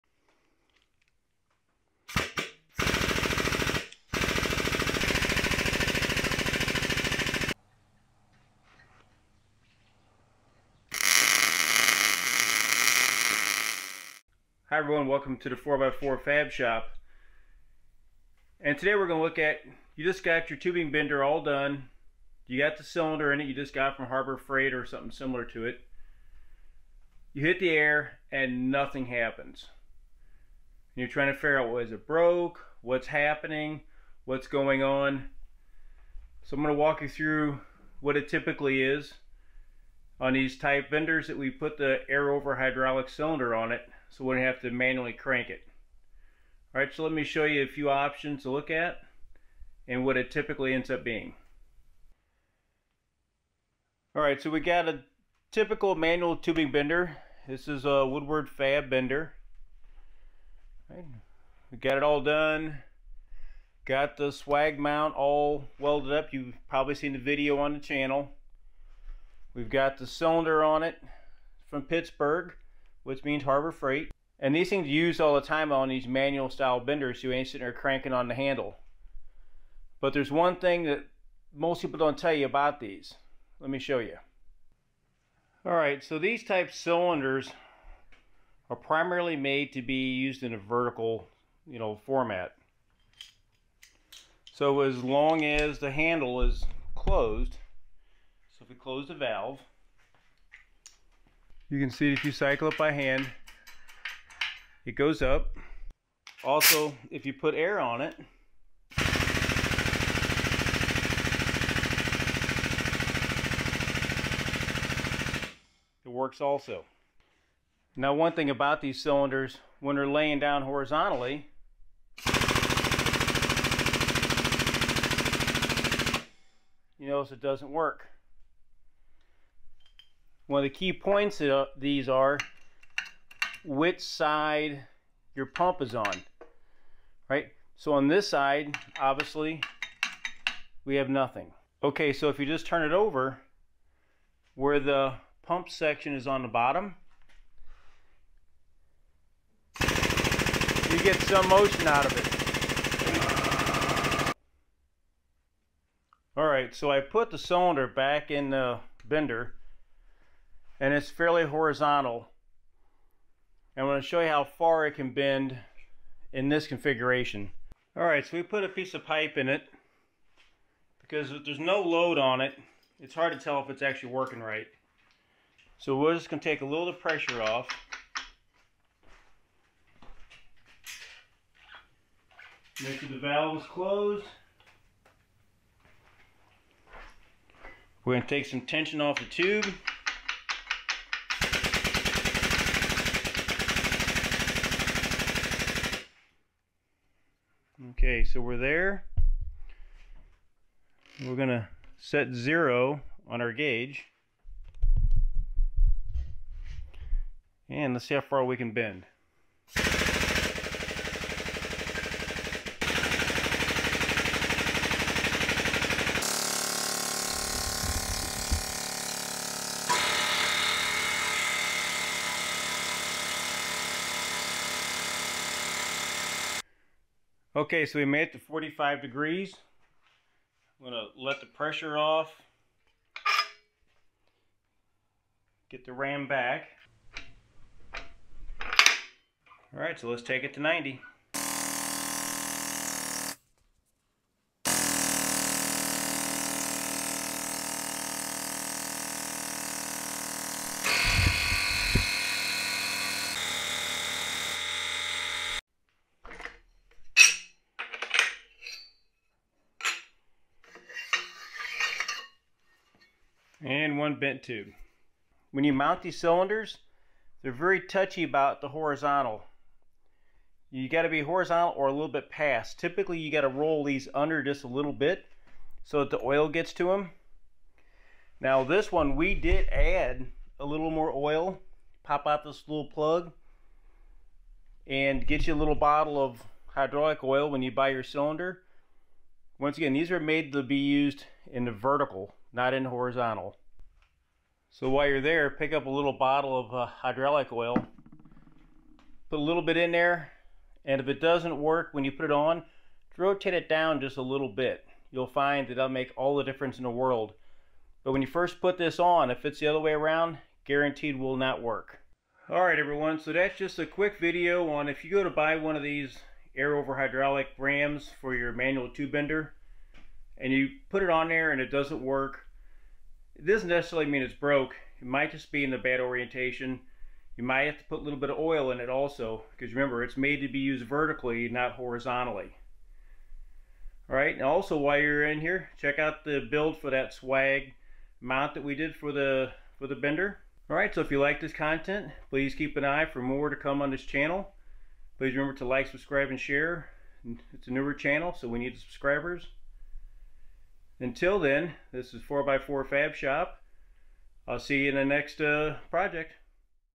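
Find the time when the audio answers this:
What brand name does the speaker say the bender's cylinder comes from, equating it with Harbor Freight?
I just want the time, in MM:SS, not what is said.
01:11.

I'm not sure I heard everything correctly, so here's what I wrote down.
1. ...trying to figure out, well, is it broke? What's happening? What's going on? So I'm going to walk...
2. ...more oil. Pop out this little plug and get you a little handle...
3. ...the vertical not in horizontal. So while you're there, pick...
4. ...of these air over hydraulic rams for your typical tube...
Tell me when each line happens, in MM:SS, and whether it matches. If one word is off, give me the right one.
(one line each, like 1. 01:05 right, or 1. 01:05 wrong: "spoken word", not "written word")
1. 00:31 right
2. 04:40 wrong: "bottle", not "handle"
3. 04:51 right
4. 05:15 wrong: "manual", not "typical".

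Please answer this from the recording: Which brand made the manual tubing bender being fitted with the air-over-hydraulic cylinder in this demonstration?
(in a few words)
Woodward Fab.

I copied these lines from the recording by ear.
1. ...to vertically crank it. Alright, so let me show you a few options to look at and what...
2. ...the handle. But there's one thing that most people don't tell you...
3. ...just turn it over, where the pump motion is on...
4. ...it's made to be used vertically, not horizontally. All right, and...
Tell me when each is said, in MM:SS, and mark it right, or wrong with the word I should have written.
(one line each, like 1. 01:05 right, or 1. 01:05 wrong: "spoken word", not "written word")
1. 00:44 wrong: "manually", not "vertically"
2. 01:18 right
3. 02:22 wrong: "section", not "motion"
4. 05:30 right.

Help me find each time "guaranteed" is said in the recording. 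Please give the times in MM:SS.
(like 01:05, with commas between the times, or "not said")
05:10.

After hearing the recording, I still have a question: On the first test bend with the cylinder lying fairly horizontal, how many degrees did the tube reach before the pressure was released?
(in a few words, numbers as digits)
45 degrees.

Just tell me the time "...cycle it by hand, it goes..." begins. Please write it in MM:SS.
01:42.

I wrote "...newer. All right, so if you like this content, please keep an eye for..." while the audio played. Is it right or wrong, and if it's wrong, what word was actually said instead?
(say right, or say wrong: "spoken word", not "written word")
wrong: "bender", not "newer".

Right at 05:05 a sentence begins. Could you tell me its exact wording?
You'll find that that'll make all the difference in the world.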